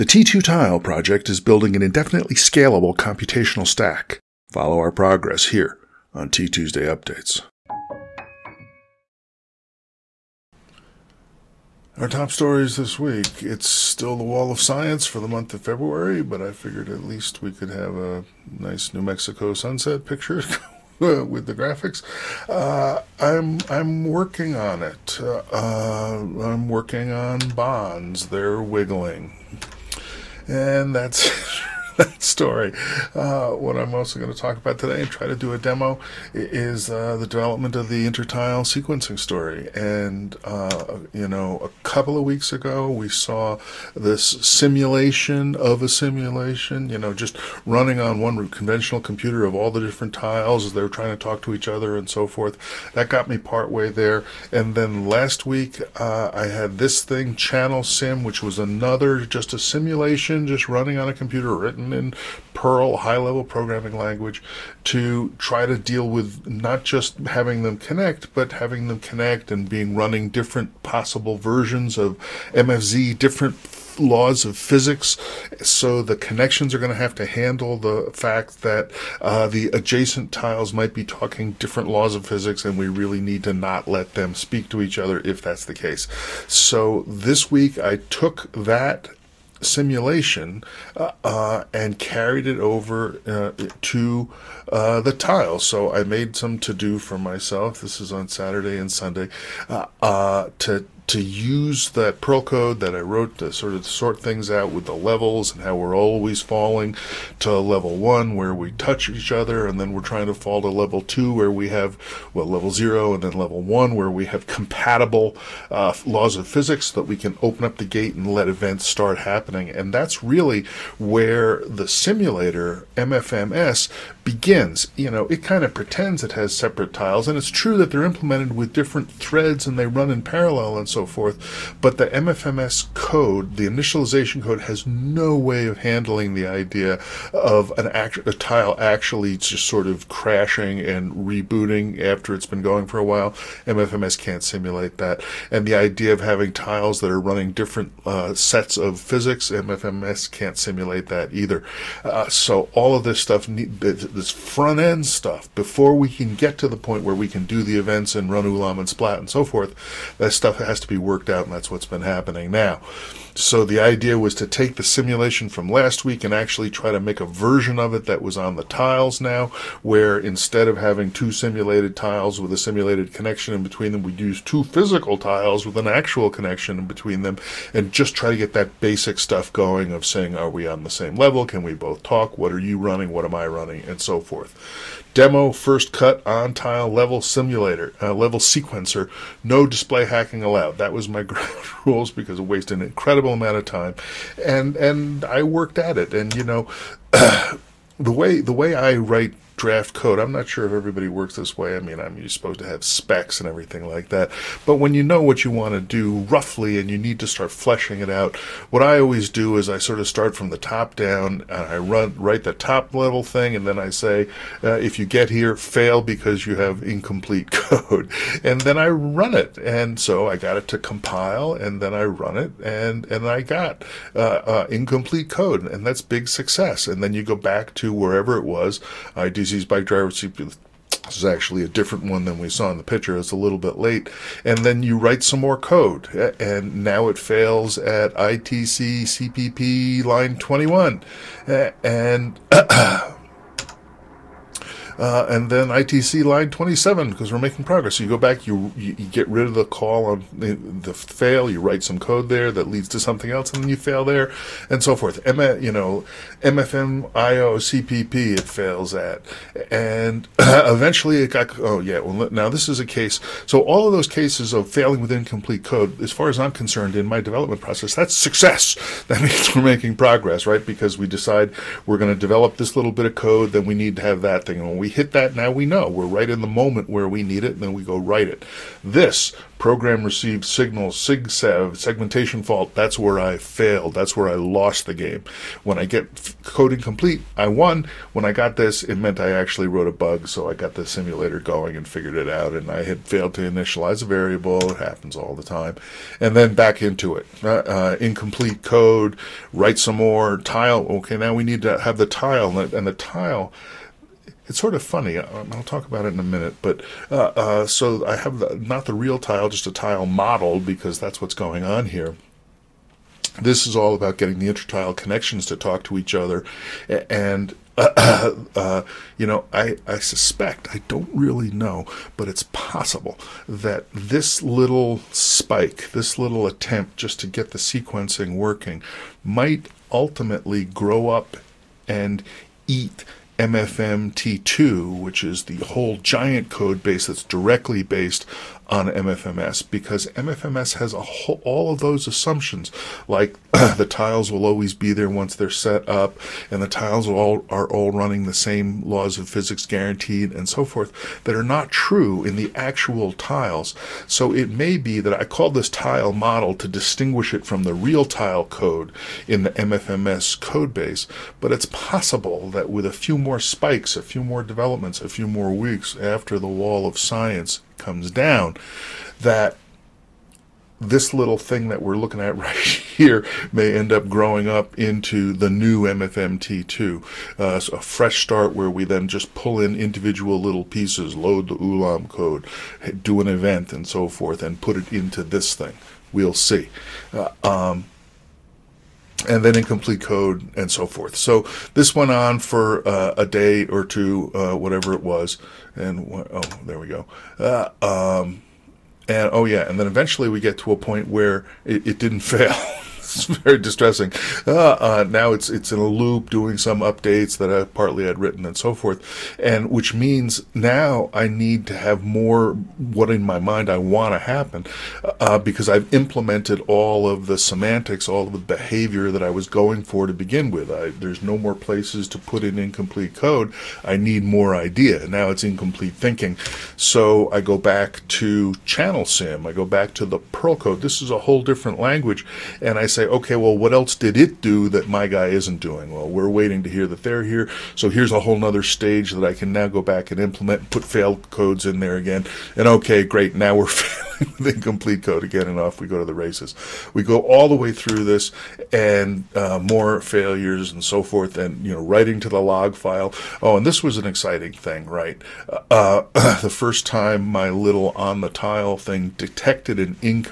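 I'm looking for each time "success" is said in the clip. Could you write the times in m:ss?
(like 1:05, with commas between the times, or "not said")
3:46, 4:28.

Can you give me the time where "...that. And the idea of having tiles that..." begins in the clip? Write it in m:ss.
2:24.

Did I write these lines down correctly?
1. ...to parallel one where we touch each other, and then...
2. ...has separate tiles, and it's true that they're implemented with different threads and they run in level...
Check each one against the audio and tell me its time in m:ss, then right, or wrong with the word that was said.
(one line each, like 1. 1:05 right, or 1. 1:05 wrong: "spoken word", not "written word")
1. 1:47 wrong: "level", not "parallel"
2. 2:06 wrong: "parallel", not "level".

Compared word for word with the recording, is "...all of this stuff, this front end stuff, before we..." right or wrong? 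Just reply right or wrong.
right.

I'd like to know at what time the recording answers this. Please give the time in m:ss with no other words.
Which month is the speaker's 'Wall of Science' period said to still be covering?
0:15.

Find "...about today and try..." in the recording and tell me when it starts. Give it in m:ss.
0:34.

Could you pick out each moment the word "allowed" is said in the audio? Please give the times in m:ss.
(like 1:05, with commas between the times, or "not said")
3:10.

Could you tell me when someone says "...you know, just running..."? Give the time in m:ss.
0:46.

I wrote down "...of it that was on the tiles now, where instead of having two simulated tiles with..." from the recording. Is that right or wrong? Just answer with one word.
right.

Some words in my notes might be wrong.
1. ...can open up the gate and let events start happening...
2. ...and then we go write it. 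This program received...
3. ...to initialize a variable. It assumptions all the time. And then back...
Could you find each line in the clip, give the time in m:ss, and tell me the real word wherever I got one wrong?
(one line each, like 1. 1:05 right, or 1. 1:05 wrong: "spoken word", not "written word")
1. 1:57 right
2. 4:37 right
3. 4:53 wrong: "happens", not "assumptions".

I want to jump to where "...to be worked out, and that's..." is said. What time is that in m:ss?
2:40.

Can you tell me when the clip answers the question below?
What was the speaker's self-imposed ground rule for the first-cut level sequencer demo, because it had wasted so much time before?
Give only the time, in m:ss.
3:09.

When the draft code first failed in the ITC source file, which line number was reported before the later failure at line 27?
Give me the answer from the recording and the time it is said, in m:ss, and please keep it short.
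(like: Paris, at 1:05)
21, at 4:00.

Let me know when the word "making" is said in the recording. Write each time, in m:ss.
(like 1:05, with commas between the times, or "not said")
4:07, 4:29.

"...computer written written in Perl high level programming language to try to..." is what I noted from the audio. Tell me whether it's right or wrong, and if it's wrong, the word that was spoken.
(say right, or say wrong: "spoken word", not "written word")
right.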